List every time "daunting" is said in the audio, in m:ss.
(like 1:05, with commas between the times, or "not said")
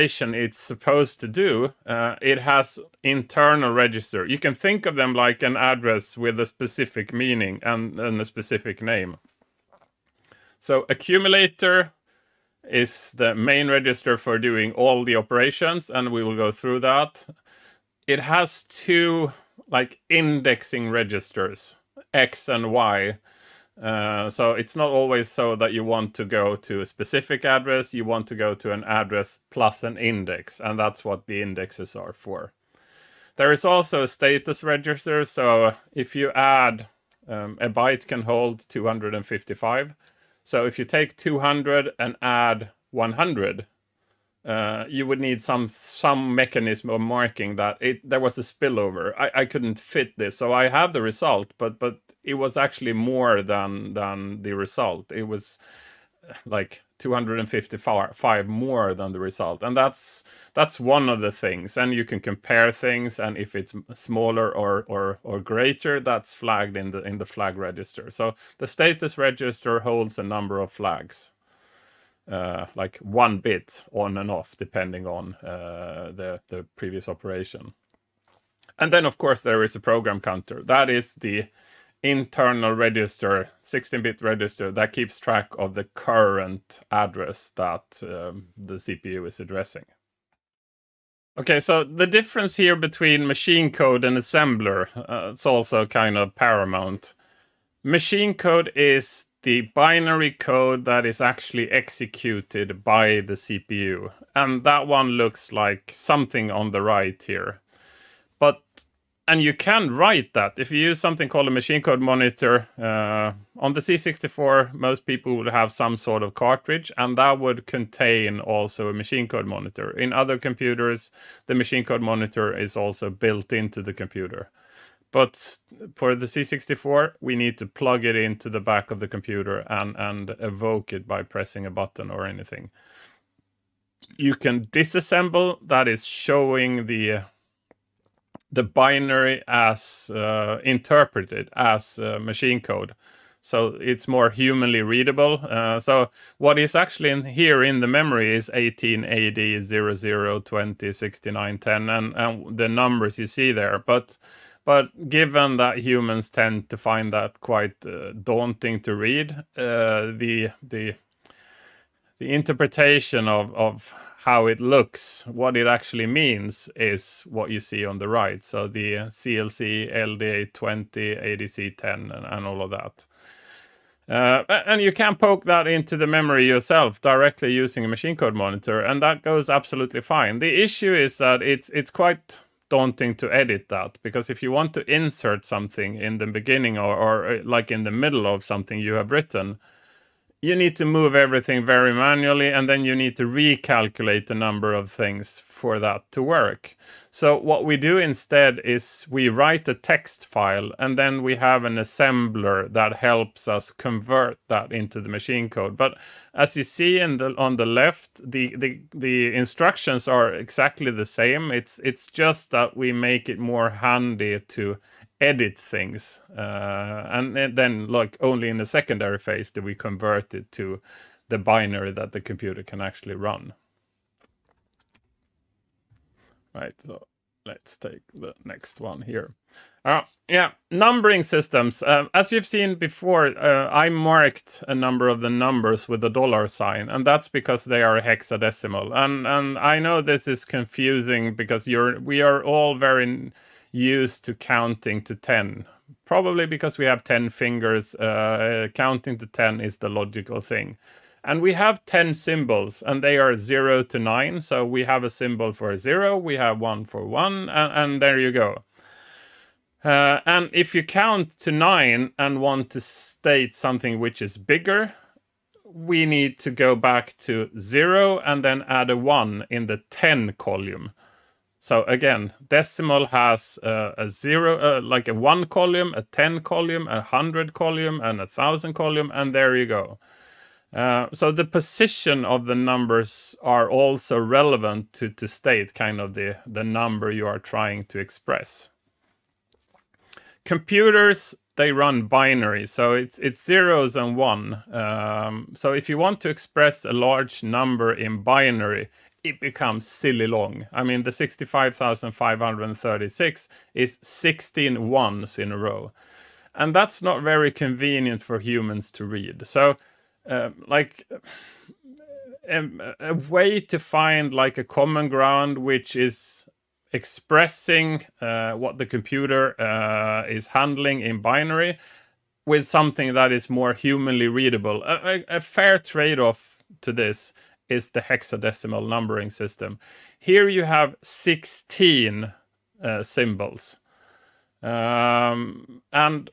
2:38, 3:02.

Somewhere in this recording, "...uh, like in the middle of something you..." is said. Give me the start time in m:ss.
3:07.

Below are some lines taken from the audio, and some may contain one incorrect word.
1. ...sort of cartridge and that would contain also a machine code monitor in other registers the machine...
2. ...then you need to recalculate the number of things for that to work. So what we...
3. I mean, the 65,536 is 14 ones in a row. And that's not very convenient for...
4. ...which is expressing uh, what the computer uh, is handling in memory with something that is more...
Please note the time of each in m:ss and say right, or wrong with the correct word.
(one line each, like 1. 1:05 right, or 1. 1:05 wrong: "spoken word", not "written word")
1. 1:55 wrong: "computers", not "registers"
2. 3:12 right
3. 5:00 wrong: "16", not "14"
4. 5:15 wrong: "binary", not "memory".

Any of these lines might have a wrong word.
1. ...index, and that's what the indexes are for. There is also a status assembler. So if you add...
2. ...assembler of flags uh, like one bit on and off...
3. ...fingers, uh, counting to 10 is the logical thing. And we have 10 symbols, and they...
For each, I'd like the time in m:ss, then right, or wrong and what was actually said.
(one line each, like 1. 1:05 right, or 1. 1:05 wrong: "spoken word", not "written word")
1. 0:29 wrong: "register", not "assembler"
2. 1:10 wrong: "number", not "assembler"
3. 4:07 right.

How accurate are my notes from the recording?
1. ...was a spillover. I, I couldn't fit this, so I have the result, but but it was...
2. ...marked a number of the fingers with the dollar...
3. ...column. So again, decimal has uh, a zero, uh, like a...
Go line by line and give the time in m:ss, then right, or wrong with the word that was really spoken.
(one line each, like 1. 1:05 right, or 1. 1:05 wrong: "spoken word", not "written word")
1. 0:48 right
2. 3:53 wrong: "numbers", not "fingers"
3. 4:30 right.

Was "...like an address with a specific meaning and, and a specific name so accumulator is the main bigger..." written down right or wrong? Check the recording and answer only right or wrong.
wrong.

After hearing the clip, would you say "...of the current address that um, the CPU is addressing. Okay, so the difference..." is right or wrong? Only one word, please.
right.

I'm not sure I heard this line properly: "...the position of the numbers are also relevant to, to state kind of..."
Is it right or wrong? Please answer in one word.
right.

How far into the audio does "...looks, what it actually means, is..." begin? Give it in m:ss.
2:44.